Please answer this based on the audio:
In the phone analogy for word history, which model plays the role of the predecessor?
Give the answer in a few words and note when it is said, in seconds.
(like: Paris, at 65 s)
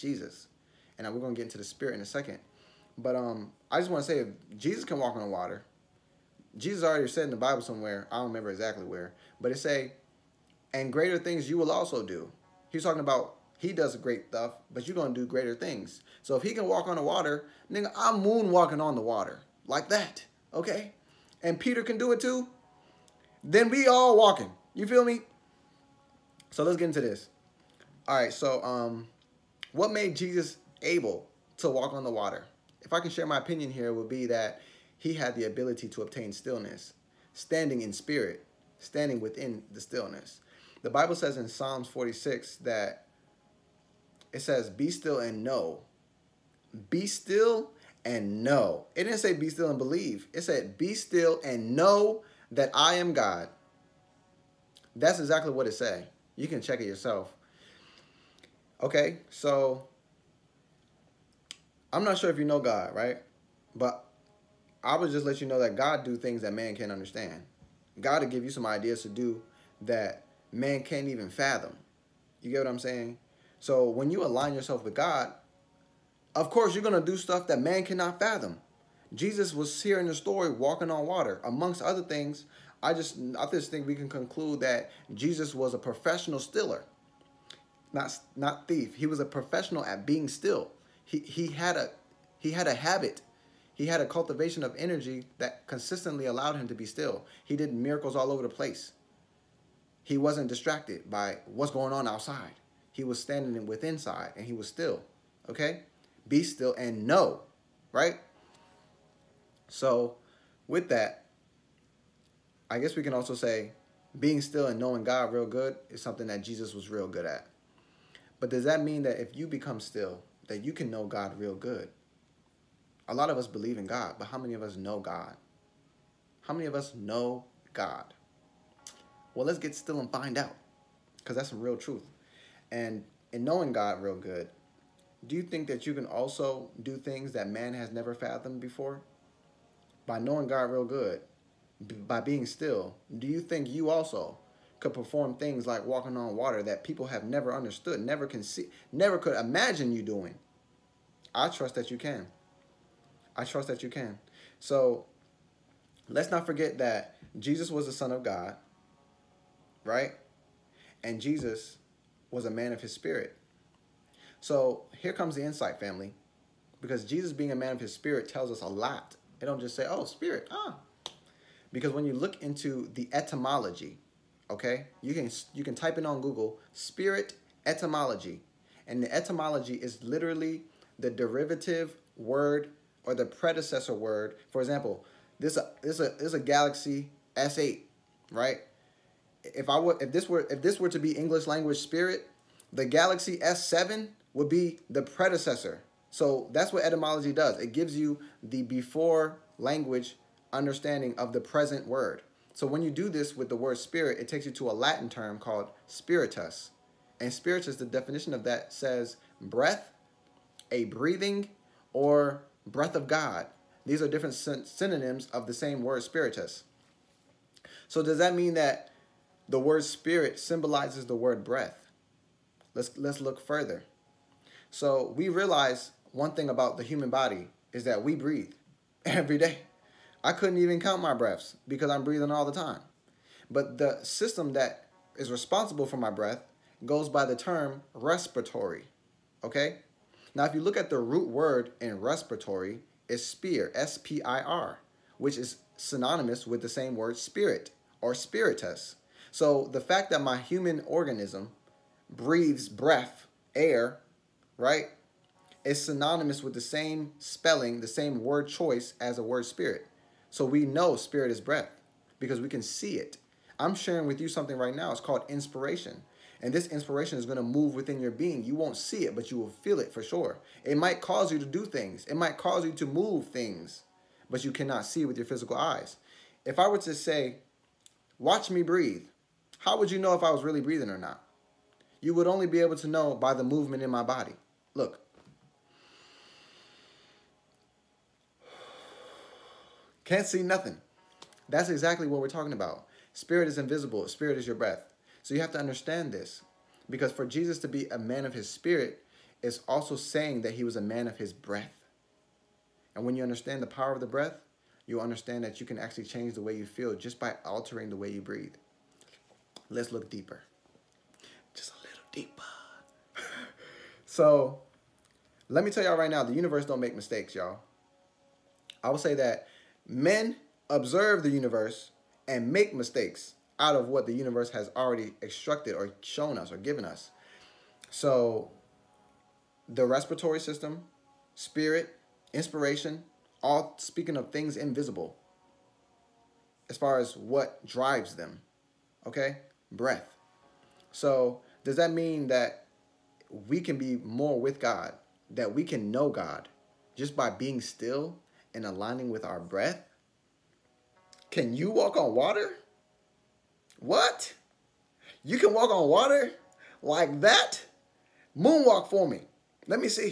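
Galaxy S7, at 192 s.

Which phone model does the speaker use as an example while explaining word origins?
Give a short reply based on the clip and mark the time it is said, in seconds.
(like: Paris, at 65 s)
Galaxy S8, at 186 s.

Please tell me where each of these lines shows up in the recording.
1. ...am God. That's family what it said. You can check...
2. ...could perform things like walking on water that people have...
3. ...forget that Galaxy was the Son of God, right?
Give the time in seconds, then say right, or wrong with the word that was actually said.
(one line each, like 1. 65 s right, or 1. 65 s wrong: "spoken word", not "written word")
1. 52 s wrong: "exactly", not "family"
2. 144 s right
3. 156 s wrong: "Jesus", not "Galaxy".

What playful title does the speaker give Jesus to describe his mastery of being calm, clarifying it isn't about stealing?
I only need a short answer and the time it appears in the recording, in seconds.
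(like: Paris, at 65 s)
professional stiller, at 85 s.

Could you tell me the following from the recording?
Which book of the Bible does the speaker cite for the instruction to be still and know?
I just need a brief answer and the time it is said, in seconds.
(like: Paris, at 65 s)
Psalms 46, at 41 s.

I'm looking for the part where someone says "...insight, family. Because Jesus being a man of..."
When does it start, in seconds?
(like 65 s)
165 s.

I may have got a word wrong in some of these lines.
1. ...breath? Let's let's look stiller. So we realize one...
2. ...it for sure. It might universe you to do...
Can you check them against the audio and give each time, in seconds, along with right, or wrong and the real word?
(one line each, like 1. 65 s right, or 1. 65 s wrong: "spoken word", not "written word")
1. 221 s wrong: "further", not "stiller"
2. 269 s wrong: "cause", not "universe".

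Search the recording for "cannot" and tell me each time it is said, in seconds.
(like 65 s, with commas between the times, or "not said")
77 s, 274 s.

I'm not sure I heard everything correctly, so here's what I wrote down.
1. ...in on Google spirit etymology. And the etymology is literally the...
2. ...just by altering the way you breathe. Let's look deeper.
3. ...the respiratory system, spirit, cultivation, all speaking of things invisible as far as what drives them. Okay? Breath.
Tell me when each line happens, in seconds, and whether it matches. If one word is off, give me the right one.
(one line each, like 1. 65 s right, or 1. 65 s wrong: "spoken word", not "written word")
1. 175 s right
2. 306 s right
3. 329 s wrong: "inspiration", not "cultivation".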